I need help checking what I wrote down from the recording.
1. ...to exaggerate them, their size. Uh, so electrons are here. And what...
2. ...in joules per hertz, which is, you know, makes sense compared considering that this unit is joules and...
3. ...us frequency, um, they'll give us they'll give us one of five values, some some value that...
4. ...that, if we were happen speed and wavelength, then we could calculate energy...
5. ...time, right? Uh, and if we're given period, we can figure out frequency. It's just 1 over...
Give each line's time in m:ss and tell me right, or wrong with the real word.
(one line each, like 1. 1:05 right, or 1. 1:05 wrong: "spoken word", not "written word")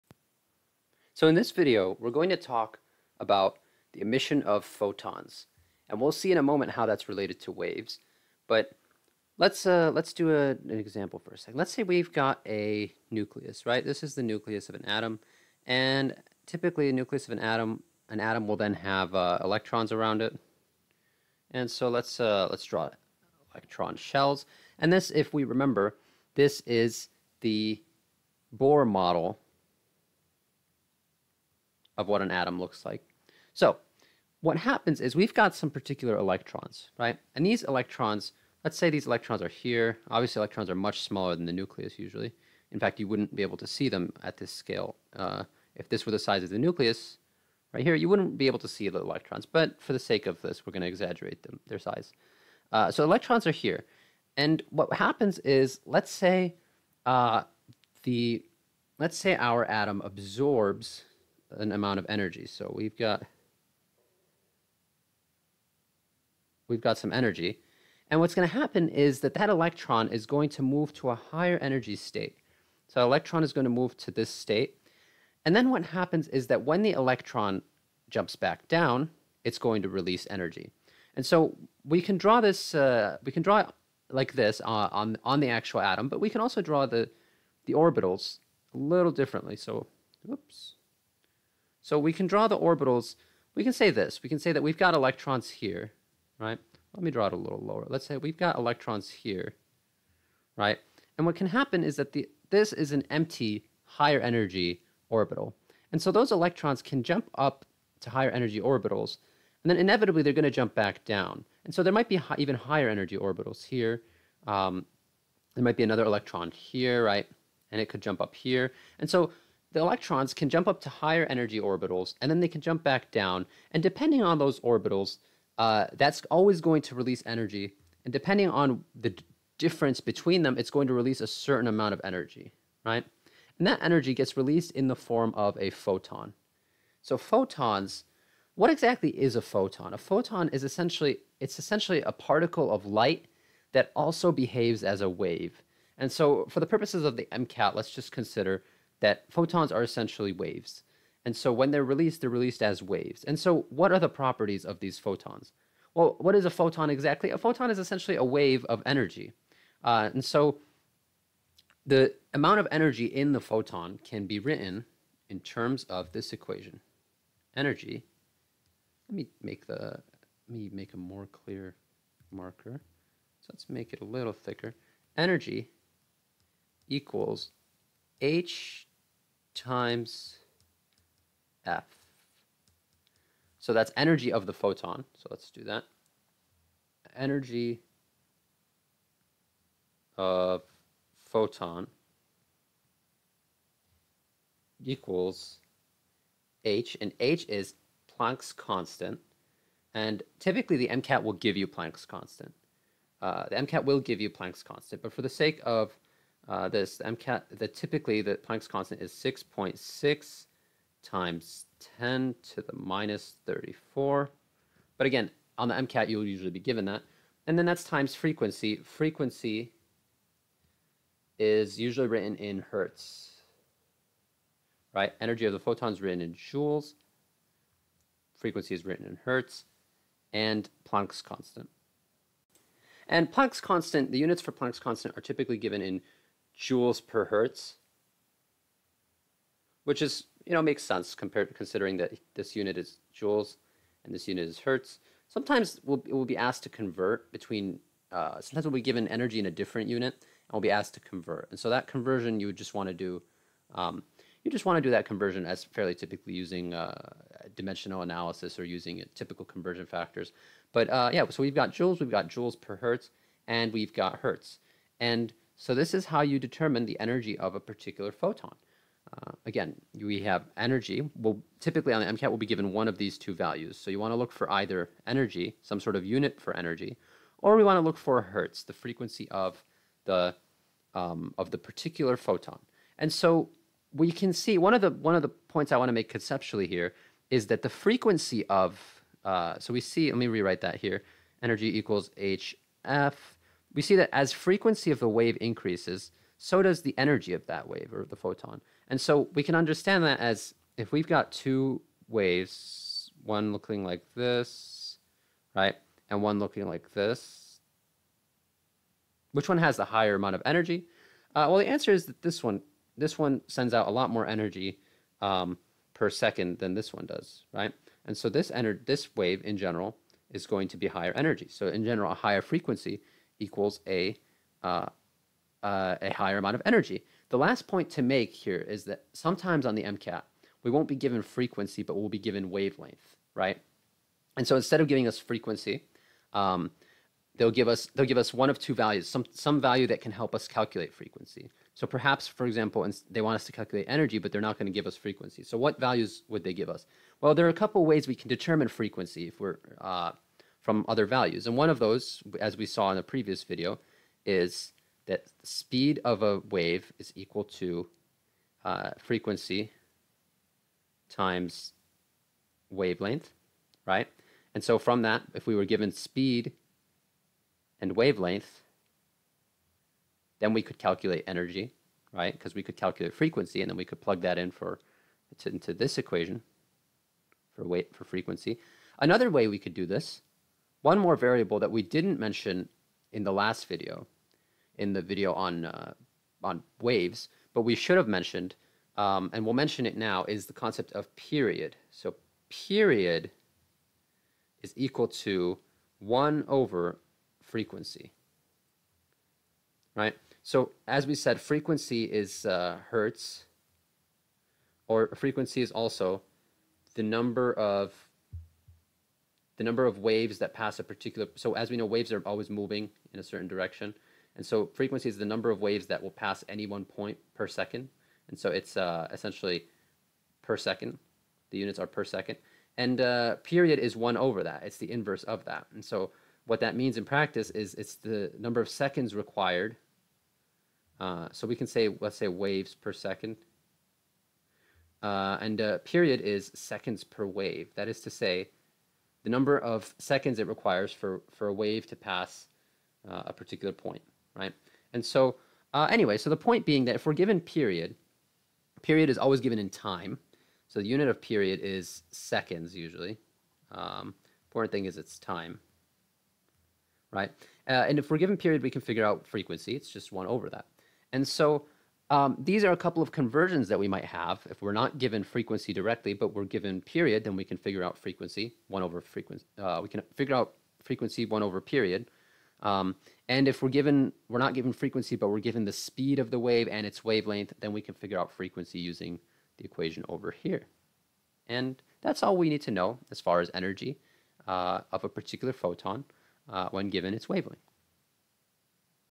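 1. 0:50 right
2. 3:55 right
3. 5:35 wrong: "two", not "five"
4. 6:05 wrong: "given", not "happen"
5. 7:35 right.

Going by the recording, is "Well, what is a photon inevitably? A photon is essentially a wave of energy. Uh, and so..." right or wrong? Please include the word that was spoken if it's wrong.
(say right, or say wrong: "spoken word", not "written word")
wrong: "exactly", not "inevitably".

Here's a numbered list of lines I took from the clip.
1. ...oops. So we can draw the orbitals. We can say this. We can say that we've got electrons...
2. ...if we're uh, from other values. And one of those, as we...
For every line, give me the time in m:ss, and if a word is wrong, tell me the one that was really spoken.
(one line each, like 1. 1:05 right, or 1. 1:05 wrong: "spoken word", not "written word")
1. 1:30 right
2. 5:49 right.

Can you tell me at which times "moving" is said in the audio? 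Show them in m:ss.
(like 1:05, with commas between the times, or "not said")
6:52.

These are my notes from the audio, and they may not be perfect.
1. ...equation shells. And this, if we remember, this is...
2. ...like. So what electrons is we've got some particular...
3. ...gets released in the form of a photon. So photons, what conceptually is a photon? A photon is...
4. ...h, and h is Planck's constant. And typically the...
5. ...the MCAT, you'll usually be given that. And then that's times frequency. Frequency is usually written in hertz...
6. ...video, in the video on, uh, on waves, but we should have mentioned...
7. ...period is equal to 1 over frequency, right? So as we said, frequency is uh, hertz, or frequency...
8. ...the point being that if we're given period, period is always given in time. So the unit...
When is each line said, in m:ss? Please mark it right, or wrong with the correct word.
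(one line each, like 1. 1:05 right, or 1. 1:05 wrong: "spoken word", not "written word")
1. 0:23 wrong: "electron", not "equation"
2. 0:32 wrong: "happens", not "electrons"
3. 2:14 wrong: "exactly", not "conceptually"
4. 3:16 right
5. 3:35 right
6. 6:23 right
7. 6:32 right
8. 7:26 right.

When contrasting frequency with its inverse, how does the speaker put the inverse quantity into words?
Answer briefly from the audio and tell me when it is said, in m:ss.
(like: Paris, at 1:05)
seconds per wave, at 7:16.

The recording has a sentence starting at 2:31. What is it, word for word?
And so when they're released, they're released as waves.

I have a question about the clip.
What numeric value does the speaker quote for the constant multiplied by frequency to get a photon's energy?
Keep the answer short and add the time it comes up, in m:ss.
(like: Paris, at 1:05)
6.6 x 10^-34, at 3:29.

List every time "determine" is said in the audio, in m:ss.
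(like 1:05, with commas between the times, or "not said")
4:26, 5:48.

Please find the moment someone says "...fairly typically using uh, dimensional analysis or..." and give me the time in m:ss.
4:15.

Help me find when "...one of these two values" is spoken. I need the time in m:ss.
4:32.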